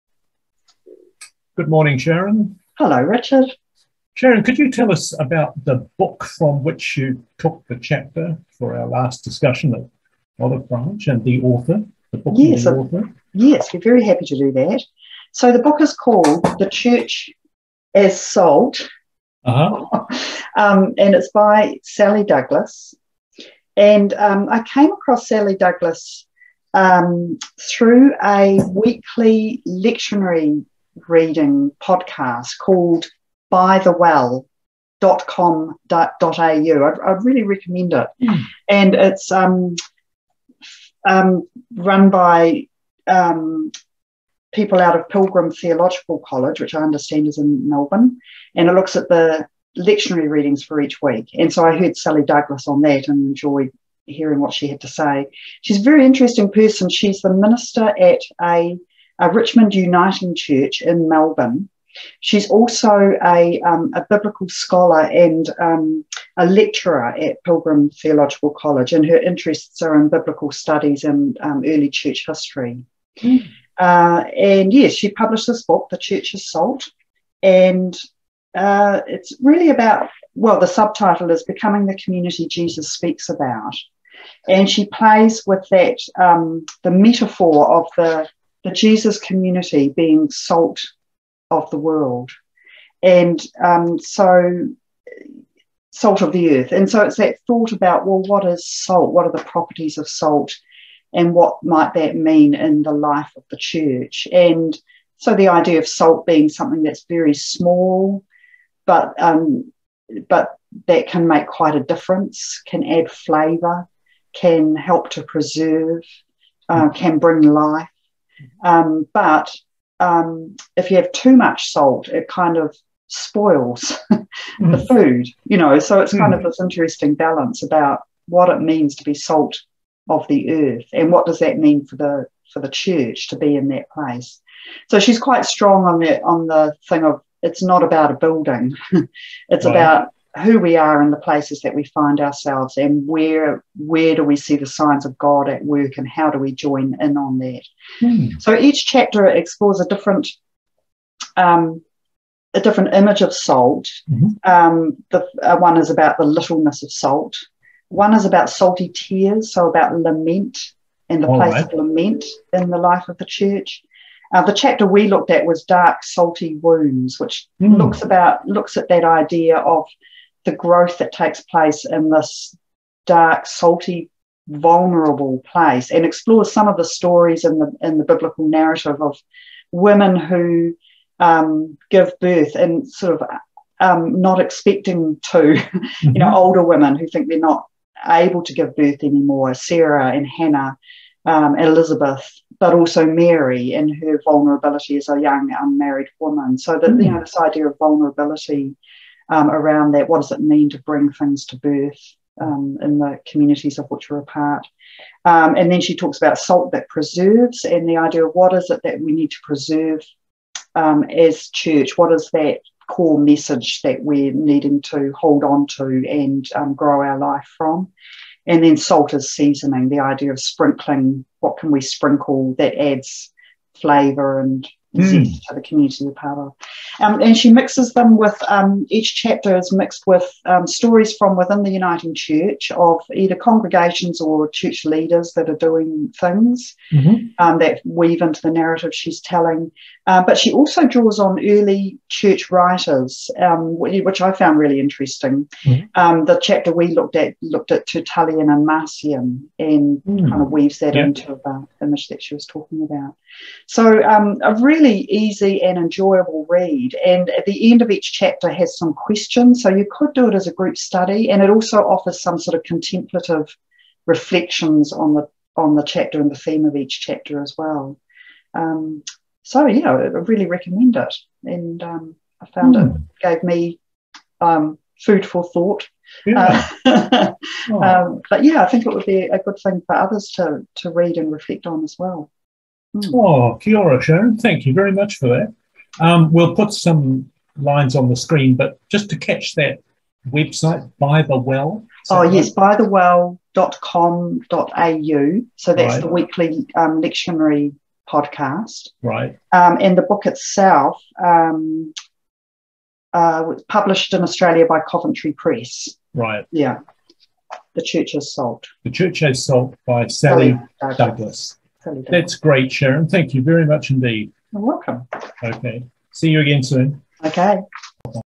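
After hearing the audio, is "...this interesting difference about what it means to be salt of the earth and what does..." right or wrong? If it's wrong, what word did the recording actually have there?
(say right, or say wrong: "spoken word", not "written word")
wrong: "balance", not "difference".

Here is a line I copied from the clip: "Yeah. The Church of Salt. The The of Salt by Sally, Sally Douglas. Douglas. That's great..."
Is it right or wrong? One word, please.
wrong.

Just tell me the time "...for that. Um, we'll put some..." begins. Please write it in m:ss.
4:45.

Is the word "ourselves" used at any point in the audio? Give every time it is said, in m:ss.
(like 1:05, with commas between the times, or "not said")
2:22.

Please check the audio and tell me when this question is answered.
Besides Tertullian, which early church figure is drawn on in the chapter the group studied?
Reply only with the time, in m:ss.
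4:08.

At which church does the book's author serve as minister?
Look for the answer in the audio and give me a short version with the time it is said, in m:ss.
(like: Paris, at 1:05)
Richmond Uniting Church, at 0:59.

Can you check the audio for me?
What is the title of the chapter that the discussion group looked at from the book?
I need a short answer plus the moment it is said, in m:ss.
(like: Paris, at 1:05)
Dark, Salty Wounds, at 2:45.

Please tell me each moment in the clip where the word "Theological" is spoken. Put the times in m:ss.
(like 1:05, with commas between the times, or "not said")
0:45, 1:07.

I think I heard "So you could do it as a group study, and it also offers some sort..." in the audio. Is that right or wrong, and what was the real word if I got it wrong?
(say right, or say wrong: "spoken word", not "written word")
right.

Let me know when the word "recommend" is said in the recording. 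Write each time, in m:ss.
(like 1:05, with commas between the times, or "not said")
0:37, 4:30.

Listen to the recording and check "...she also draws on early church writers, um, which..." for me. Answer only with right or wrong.
right.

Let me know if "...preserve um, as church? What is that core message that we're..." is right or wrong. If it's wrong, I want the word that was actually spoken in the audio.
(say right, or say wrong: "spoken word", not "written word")
right.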